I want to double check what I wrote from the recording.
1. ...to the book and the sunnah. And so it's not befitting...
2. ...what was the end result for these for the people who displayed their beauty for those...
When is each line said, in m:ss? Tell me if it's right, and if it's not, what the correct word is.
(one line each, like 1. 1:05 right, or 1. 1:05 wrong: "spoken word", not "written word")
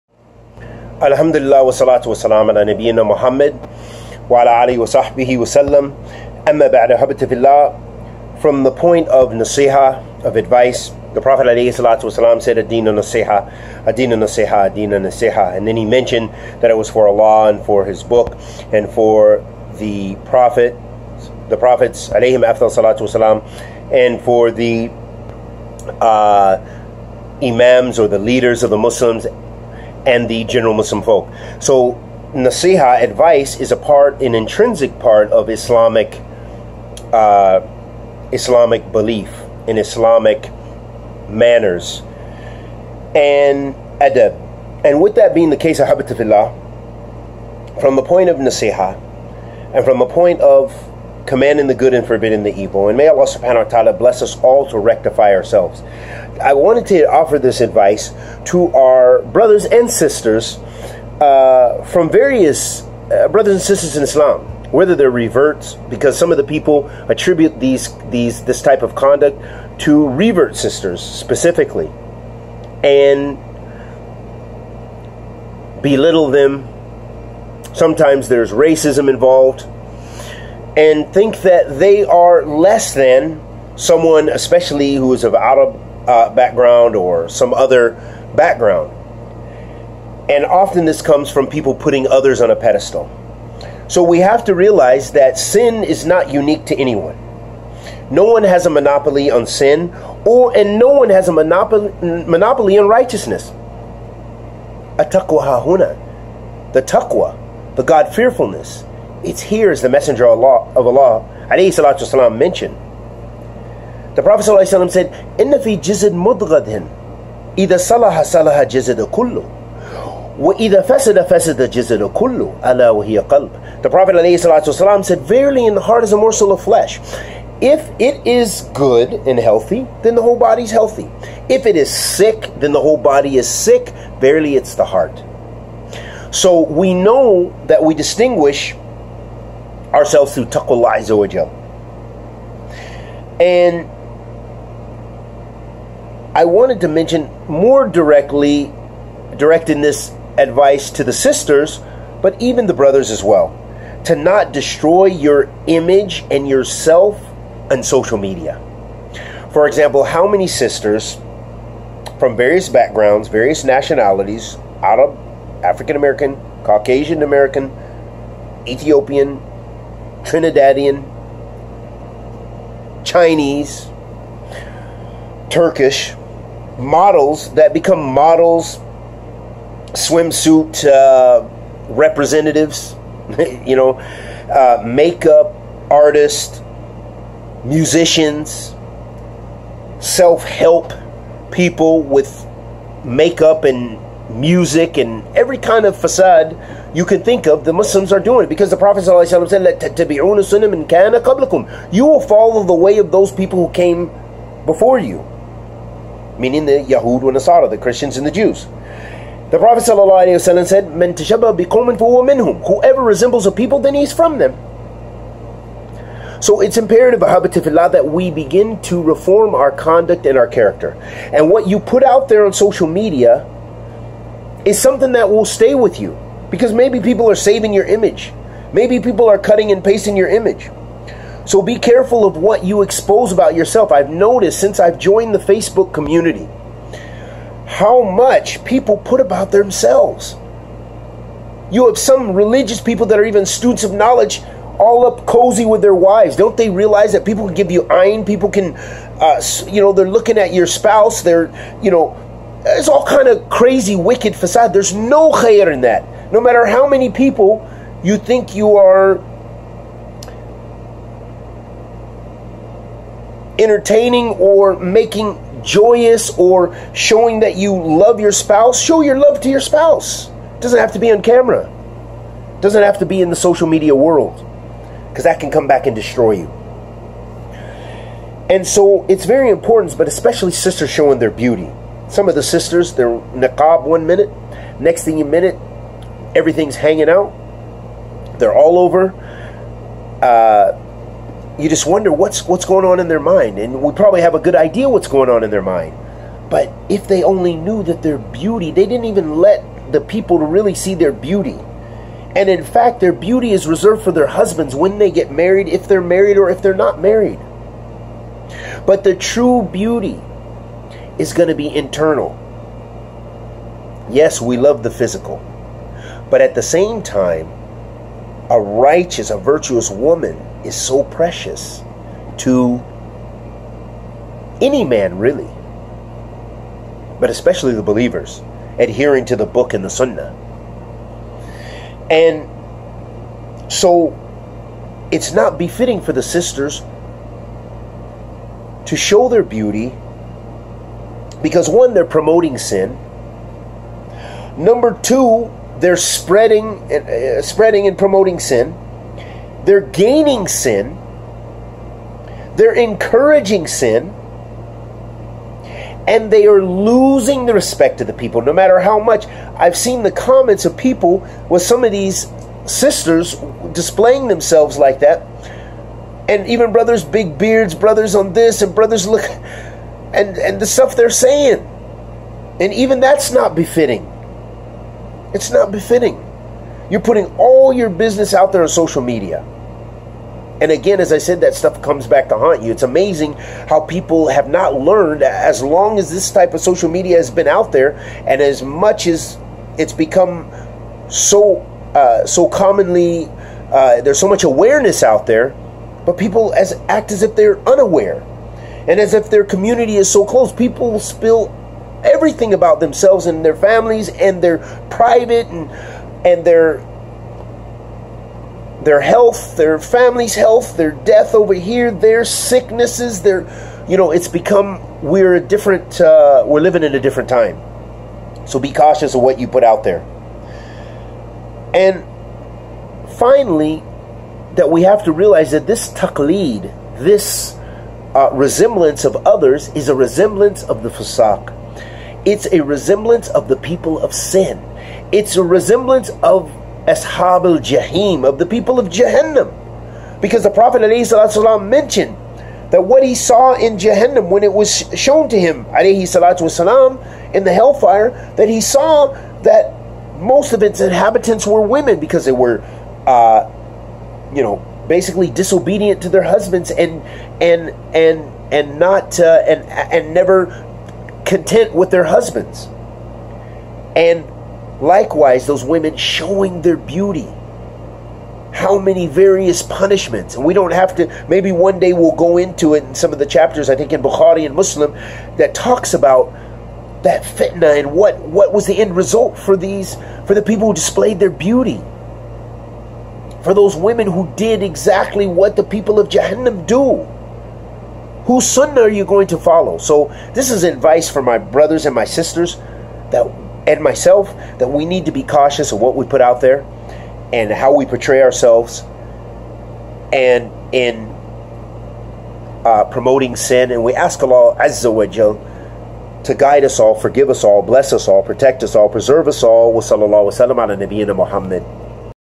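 1. 5:29 right
2. 7:58 right.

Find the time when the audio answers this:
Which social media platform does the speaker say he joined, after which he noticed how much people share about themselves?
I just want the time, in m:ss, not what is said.
3:55.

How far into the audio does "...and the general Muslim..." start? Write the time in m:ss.
0:30.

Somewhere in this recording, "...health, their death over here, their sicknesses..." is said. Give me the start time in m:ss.
6:50.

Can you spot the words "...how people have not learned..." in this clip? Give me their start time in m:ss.
6:23.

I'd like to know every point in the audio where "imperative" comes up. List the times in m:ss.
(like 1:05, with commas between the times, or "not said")
3:36.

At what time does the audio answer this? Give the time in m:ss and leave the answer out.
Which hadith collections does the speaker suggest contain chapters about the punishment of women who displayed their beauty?
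7:54.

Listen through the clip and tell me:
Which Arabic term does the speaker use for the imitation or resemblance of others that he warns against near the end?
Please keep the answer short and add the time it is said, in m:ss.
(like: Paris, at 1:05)
Taqlid, at 7:05.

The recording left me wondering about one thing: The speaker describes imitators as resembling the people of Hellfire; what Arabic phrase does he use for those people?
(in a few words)
Ashab al Jahim.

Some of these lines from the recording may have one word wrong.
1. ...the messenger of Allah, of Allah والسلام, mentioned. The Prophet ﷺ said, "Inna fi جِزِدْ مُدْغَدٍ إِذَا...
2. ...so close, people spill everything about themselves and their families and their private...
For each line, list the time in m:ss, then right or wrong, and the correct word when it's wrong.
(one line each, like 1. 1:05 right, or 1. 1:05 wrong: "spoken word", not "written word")
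1. 1:49 right
2. 6:40 right.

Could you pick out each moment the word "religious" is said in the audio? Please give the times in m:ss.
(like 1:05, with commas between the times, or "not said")
4:02.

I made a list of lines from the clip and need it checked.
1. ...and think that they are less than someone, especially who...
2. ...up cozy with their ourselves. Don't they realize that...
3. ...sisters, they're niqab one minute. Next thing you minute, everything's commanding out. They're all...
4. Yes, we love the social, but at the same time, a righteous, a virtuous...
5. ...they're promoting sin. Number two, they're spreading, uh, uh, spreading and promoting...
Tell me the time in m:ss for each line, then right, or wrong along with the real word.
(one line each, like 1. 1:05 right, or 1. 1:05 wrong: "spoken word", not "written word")
1. 1:20 right
2. 4:05 wrong: "wives", not "ourselves"
3. 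4:42 wrong: "hanging", not "commanding"
4. 5:14 wrong: "physical", not "social"
5. 5:41 right.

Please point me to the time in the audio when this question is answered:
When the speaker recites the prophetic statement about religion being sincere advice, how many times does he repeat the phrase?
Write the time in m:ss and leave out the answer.
0:12.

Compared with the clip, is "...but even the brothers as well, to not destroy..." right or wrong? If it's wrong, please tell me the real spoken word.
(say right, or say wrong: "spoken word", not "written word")
right.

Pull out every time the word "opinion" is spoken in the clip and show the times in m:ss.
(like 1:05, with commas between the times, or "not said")
not said.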